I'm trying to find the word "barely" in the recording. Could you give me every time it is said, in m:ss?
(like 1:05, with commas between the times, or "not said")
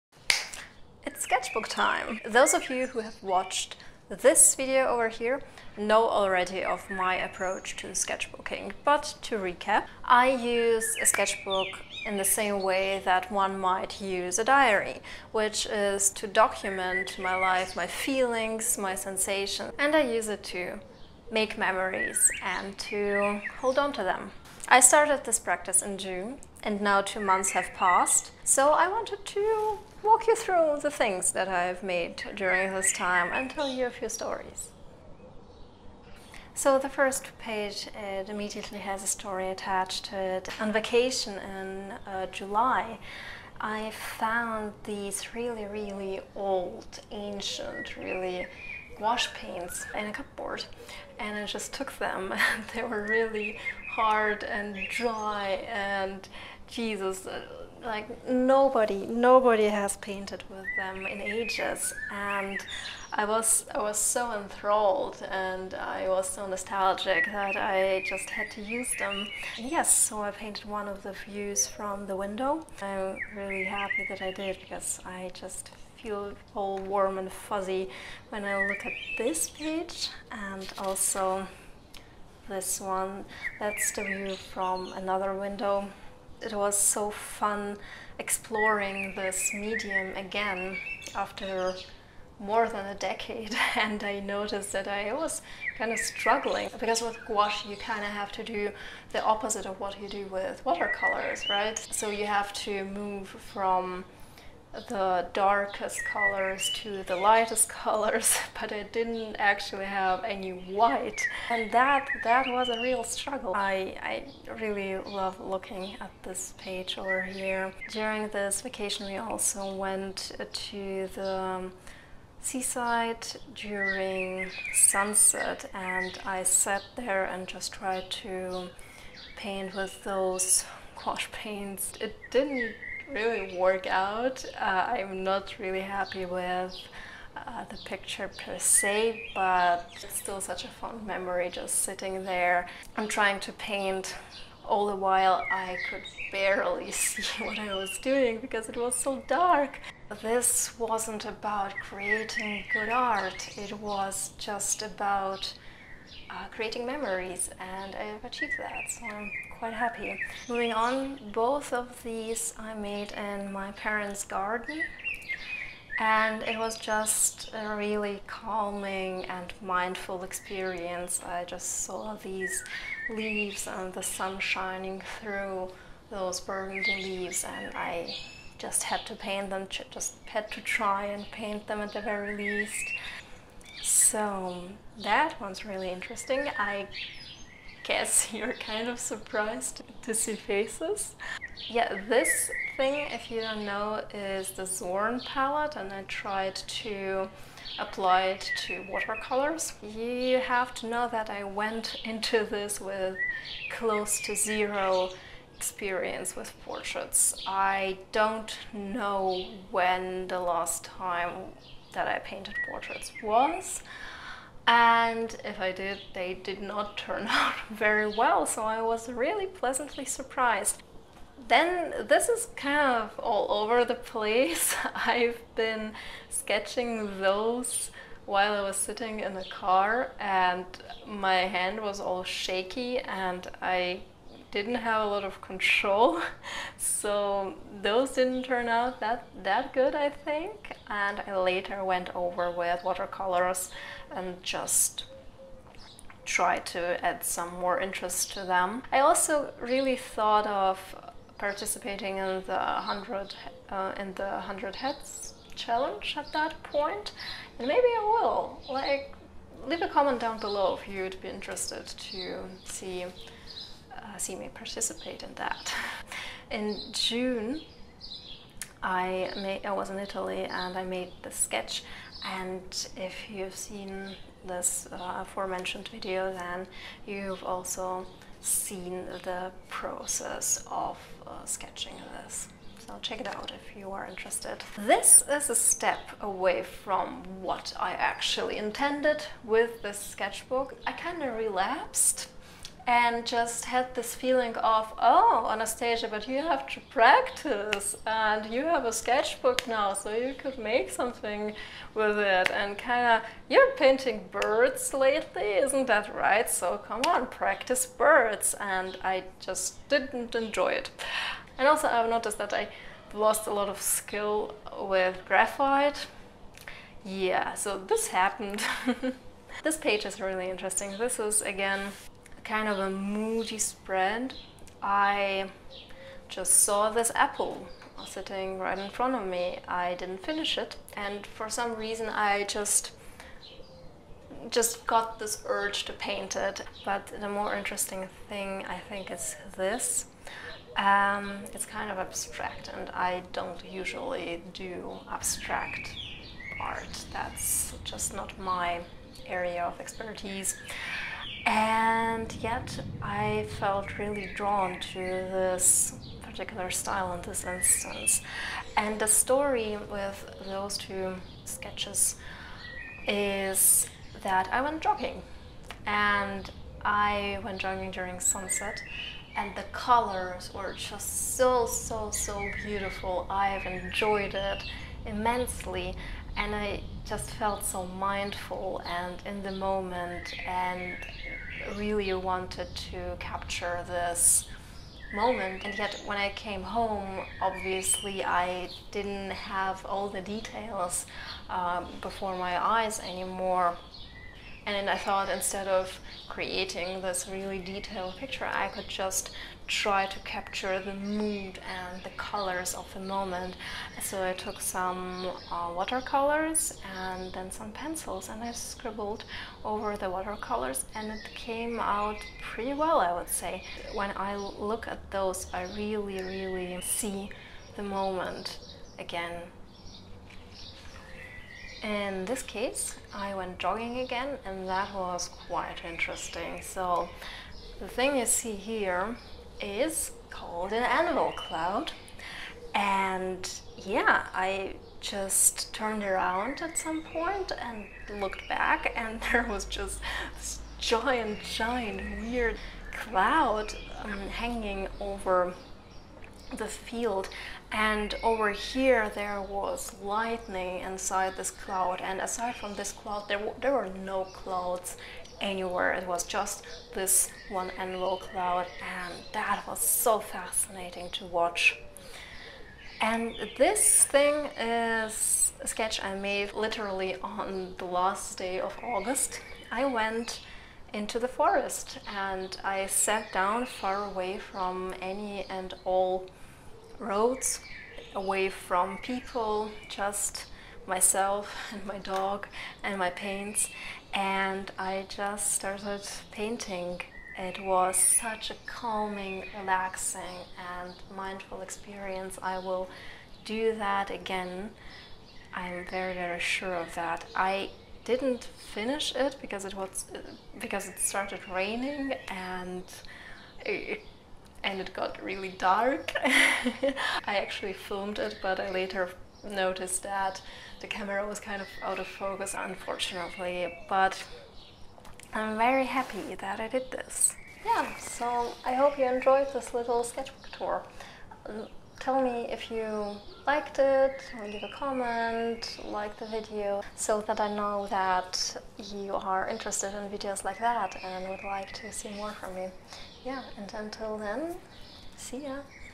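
2:26.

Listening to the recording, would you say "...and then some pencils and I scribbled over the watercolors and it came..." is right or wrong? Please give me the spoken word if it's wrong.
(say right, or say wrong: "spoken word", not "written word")
right.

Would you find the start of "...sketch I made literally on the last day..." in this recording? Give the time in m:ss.
7:45.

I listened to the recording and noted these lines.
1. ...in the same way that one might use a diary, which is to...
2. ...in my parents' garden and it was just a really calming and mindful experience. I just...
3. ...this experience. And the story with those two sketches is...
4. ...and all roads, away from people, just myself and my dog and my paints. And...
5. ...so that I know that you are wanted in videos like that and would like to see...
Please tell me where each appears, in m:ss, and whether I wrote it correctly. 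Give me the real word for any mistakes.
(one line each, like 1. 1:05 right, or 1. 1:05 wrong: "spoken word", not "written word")
1. 0:12 right
2. 2:43 right
3. 5:57 wrong: "instance", not "experience"
4. 7:55 right
5. 8:46 wrong: "interested", not "wanted".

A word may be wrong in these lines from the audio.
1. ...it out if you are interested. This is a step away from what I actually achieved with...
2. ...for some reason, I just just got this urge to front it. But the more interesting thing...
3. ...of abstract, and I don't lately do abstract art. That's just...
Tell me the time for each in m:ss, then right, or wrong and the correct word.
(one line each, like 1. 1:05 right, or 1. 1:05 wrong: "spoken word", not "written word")
1. 4:43 wrong: "intended", not "achieved"
2. 5:31 wrong: "paint", not "front"
3. 5:41 wrong: "usually", not "lately".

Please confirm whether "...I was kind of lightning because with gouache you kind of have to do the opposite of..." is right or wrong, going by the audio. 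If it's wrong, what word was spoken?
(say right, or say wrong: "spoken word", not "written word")
wrong: "struggling", not "lightning".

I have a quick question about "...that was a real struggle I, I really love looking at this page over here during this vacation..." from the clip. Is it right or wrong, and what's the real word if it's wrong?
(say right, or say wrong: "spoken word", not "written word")
right.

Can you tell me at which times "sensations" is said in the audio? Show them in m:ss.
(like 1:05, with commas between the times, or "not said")
0:18.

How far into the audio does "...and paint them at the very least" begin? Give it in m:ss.
3:01.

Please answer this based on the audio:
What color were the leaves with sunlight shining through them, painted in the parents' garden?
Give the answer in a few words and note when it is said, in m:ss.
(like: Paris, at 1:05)
Burgundy, at 2:56.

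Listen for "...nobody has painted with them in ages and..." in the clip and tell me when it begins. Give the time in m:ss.
0:59.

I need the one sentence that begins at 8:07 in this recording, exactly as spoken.
It was such a calming, relaxing, and mindful experience.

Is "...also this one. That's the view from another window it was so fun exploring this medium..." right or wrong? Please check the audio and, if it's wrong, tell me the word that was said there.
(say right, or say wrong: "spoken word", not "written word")
right.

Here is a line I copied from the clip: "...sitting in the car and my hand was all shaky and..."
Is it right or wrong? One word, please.
right.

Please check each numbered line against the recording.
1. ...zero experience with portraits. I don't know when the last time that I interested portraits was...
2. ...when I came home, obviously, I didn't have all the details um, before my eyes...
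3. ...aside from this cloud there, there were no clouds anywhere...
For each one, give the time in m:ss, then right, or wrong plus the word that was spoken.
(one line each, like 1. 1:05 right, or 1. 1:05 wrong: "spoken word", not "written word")
1. 3:24 wrong: "painted", not "interested"
2. 6:26 right
3. 7:32 right.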